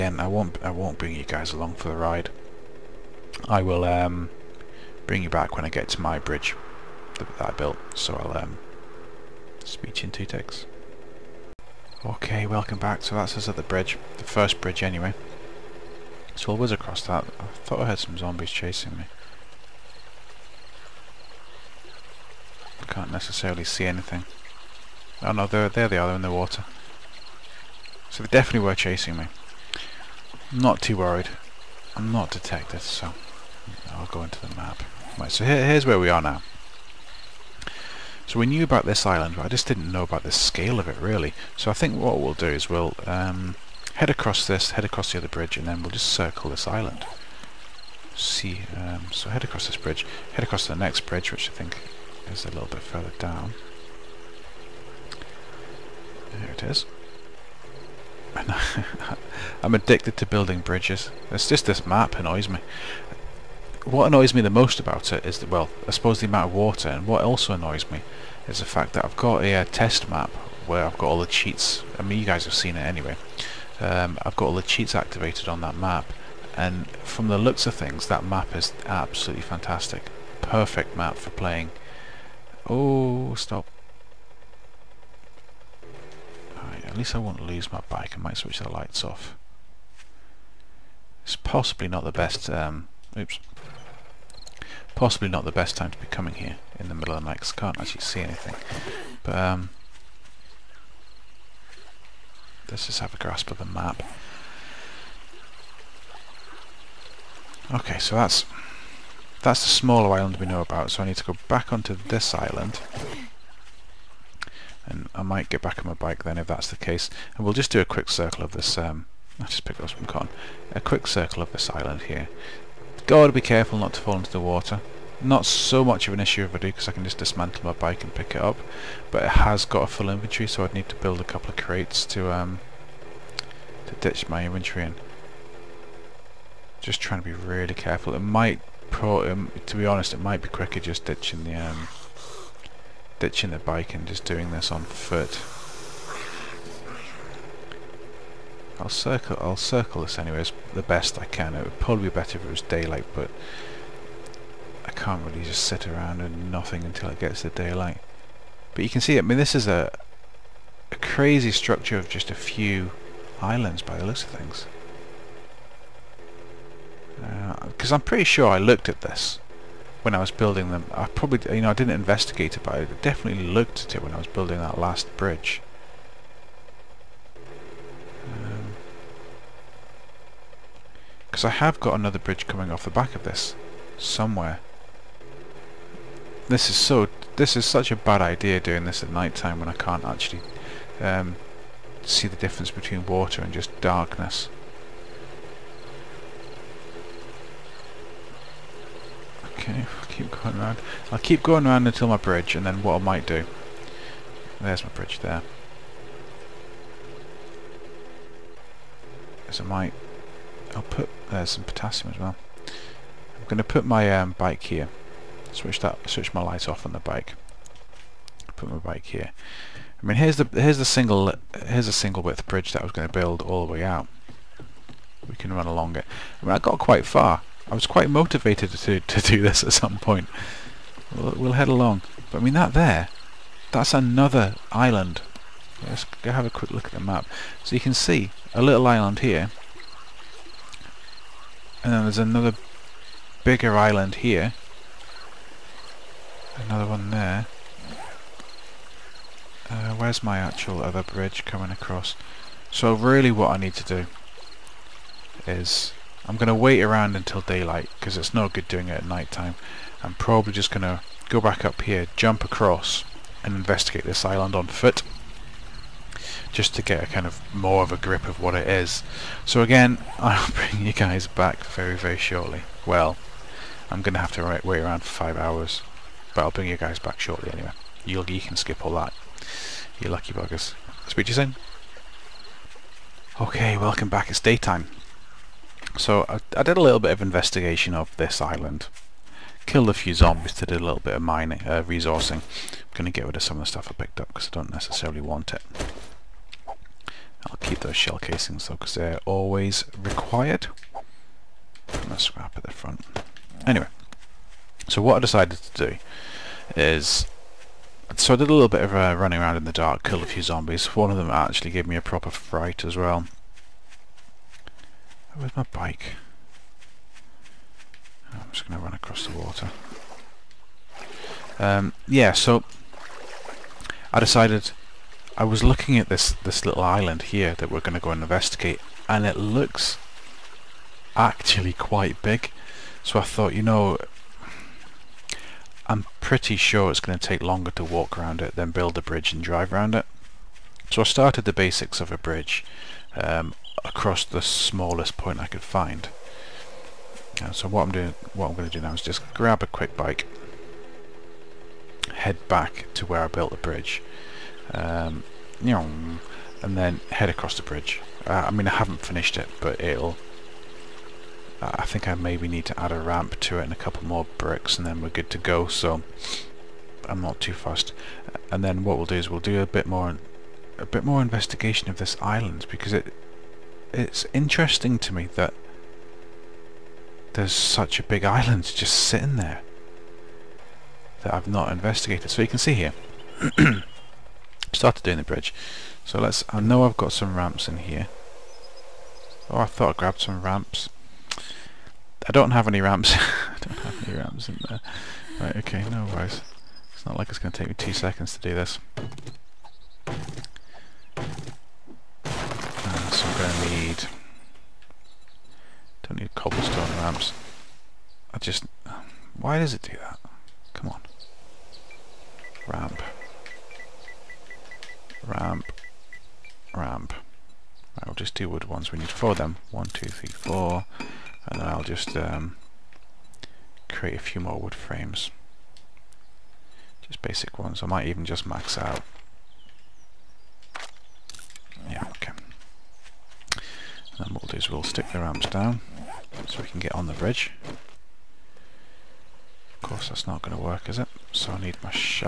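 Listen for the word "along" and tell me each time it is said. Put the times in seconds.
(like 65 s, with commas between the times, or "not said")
1 s, 225 s, 231 s.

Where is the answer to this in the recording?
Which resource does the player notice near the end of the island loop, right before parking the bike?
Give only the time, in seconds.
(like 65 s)
211 s.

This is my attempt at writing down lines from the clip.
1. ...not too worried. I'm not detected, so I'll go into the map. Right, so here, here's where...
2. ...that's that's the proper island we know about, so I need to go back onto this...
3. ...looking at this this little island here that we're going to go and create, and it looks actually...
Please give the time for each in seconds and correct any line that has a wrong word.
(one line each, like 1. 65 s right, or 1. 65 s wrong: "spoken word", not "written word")
1. 30 s right
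2. 108 s wrong: "smaller", not "proper"
3. 325 s wrong: "investigate", not "create".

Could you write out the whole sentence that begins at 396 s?
It's not like it's going to take me two seconds to do this.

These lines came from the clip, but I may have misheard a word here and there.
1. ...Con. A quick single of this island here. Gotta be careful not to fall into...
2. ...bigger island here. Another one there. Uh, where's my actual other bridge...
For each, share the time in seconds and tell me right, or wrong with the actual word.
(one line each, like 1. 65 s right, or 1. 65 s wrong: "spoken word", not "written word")
1. 120 s wrong: "circle", not "single"
2. 243 s right.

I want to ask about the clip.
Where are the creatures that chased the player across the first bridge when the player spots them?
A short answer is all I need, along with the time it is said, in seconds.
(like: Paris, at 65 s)
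In the water, at 26 s.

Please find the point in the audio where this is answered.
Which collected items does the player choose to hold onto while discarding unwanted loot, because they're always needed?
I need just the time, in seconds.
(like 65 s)
297 s.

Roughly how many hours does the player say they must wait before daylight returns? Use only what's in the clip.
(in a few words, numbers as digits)
5.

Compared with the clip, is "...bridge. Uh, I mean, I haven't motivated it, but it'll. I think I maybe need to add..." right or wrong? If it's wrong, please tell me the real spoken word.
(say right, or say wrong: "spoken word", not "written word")
wrong: "finished", not "motivated".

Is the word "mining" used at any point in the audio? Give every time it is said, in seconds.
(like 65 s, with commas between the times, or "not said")
291 s.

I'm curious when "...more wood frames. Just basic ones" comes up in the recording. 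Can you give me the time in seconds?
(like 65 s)
424 s.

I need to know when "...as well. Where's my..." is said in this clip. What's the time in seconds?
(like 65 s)
312 s.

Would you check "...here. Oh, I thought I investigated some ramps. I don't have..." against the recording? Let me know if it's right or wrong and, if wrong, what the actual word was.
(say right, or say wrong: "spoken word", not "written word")
wrong: "grabbed", not "investigated".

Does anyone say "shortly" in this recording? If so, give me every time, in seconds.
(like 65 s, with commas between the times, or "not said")
272 s, 277 s.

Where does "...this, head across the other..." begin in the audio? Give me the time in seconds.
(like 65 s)
44 s.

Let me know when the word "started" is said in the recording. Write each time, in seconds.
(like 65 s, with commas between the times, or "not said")
341 s, 384 s.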